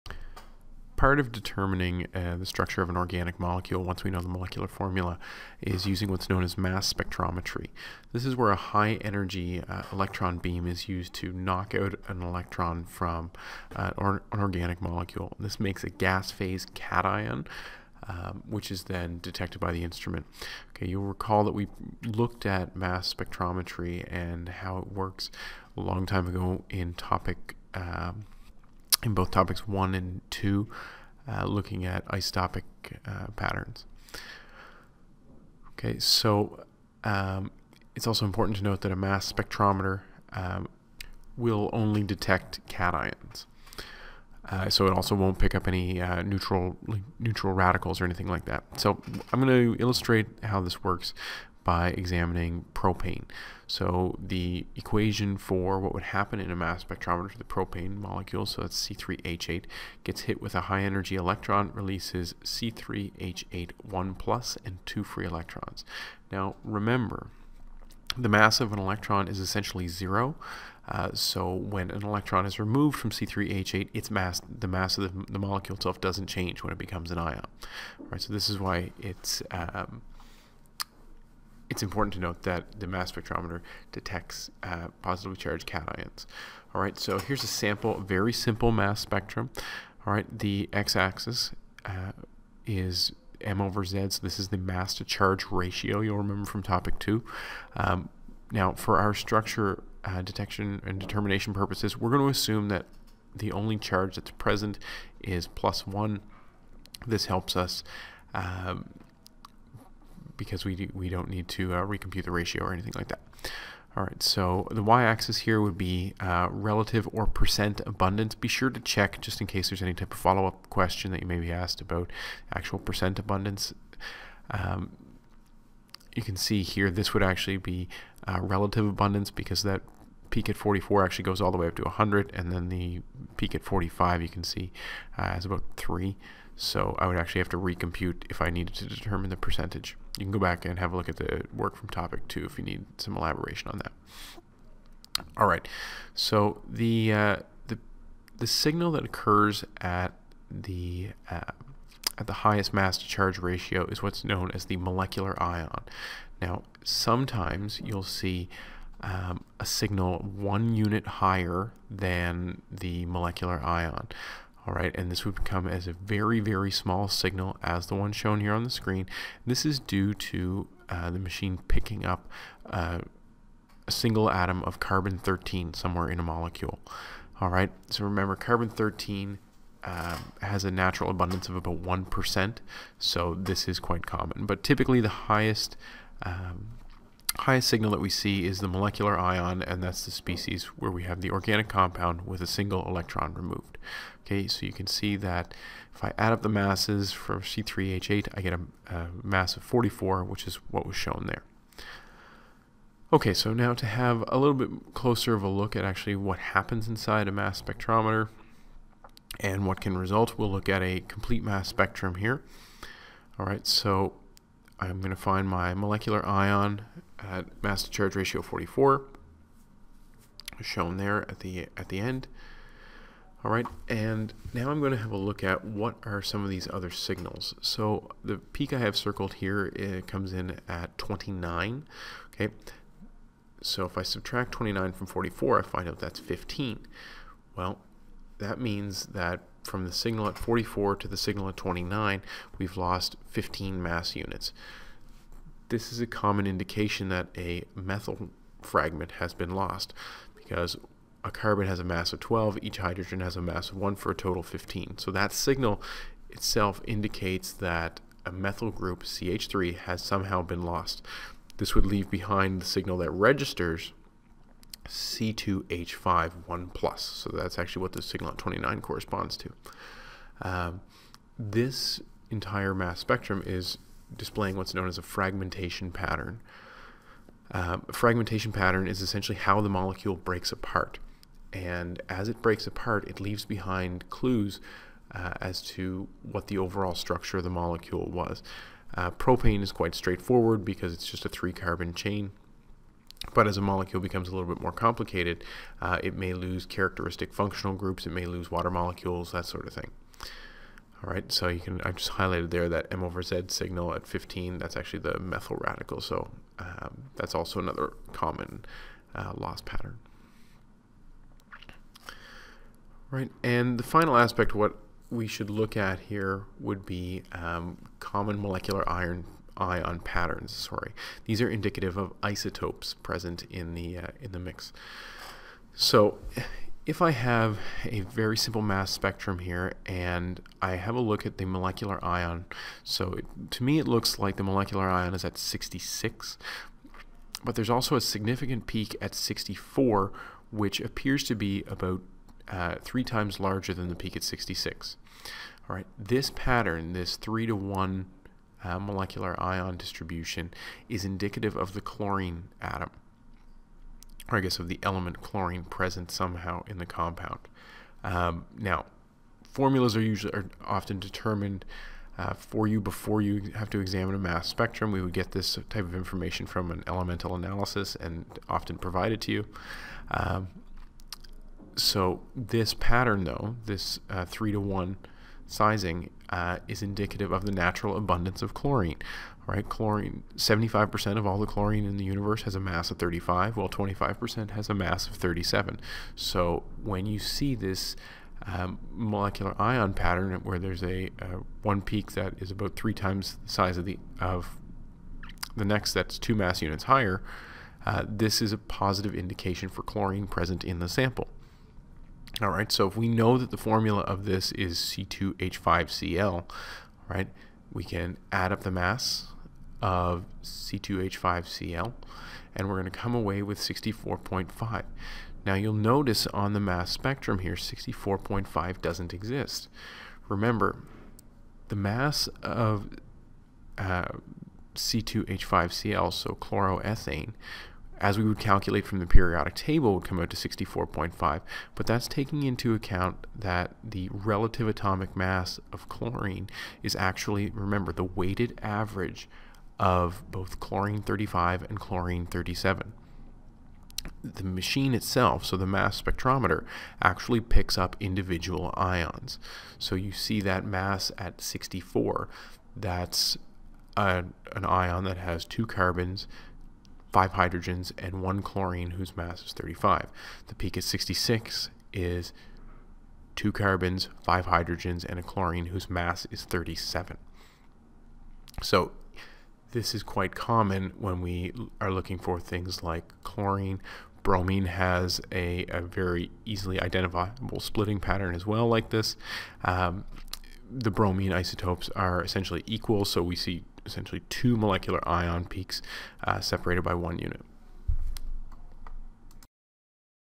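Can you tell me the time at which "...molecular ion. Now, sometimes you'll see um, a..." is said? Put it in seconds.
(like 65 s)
154 s.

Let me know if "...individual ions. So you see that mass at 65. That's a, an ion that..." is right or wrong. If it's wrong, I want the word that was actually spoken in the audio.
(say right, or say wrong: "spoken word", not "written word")
wrong: "64", not "65".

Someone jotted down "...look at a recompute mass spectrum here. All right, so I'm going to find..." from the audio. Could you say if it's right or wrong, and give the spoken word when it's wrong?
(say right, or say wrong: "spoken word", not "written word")
wrong: "complete", not "recompute".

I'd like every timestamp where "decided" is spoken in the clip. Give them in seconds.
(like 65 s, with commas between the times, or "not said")
not said.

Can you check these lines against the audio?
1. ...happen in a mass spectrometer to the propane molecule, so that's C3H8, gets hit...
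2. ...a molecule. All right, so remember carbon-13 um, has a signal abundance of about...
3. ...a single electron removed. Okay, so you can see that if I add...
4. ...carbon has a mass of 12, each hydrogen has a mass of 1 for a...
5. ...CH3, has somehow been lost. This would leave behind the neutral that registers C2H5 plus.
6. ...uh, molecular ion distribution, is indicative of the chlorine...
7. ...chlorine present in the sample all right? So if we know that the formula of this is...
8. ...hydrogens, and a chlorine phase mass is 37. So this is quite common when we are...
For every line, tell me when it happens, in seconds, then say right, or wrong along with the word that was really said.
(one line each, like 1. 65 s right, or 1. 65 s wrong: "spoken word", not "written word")
1. 56 s right
2. 176 s wrong: "natural", not "signal"
3. 192 s right
4. 251 s right
5. 259 s wrong: "signal", not "neutral"
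6. 348 s right
7. 399 s right
8. 464 s wrong: "whose", not "phase".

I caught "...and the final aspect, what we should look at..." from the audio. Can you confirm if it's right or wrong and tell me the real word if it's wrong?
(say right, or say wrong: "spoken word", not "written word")
right.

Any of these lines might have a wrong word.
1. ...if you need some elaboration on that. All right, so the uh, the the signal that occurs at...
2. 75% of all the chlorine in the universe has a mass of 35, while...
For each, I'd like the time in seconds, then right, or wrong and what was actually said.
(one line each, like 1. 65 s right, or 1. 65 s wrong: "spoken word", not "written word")
1. 142 s right
2. 380 s right.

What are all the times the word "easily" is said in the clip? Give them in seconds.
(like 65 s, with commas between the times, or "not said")
476 s.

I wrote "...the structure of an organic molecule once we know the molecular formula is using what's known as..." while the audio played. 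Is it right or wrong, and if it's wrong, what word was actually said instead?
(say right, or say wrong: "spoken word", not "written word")
right.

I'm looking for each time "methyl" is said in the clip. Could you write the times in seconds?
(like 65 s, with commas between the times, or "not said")
247 s, 258 s, 305 s.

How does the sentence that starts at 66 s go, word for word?
Now remember, the mass of an electron is essentially zero.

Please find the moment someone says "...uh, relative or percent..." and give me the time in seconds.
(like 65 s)
116 s.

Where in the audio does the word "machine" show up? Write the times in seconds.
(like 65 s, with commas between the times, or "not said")
171 s, 444 s.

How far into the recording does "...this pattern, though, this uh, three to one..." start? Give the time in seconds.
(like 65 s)
372 s.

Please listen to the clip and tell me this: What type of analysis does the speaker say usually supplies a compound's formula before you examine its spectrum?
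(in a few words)
elemental analysis.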